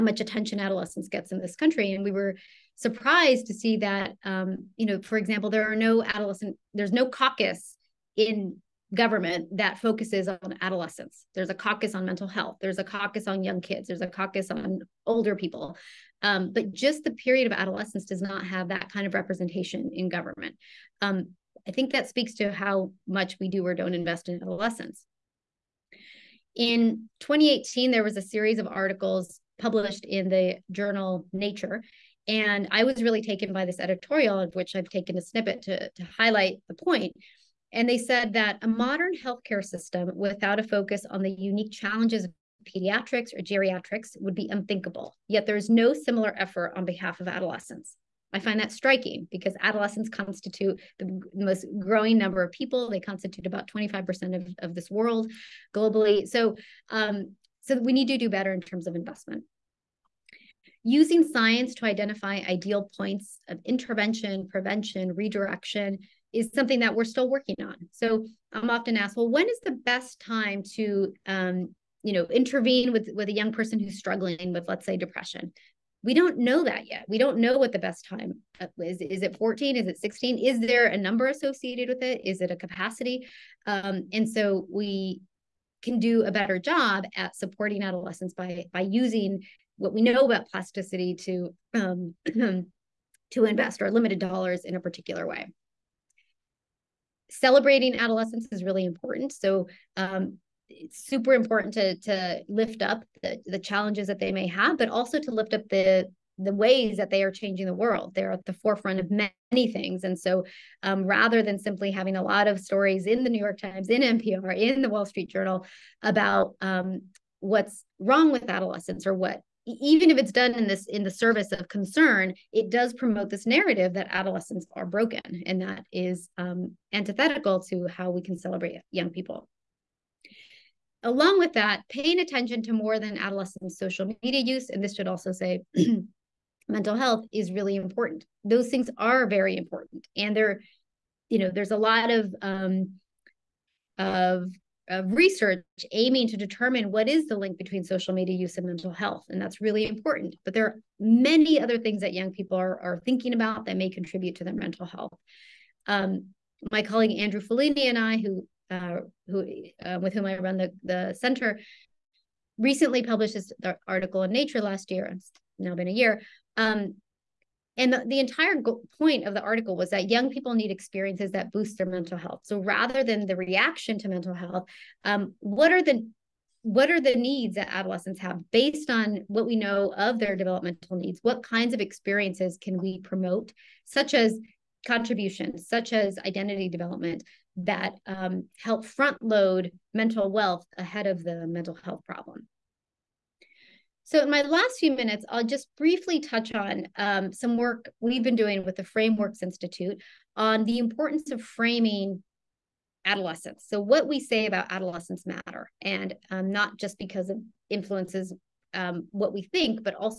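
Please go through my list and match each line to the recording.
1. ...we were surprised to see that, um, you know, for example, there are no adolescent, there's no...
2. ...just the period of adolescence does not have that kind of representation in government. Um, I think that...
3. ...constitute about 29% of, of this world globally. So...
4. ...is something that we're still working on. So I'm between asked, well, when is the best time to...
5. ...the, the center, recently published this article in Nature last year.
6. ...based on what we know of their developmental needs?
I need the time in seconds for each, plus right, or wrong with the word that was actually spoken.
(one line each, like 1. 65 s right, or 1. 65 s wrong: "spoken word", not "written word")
1. 2 s right
2. 16 s right
3. 53 s wrong: "25", not "29"
4. 66 s wrong: "often", not "between"
5. 160 s right
6. 178 s right.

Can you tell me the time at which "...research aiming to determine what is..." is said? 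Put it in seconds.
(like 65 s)
145 s.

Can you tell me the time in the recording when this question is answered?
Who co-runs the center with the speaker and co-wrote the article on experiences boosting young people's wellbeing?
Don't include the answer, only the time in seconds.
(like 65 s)
157 s.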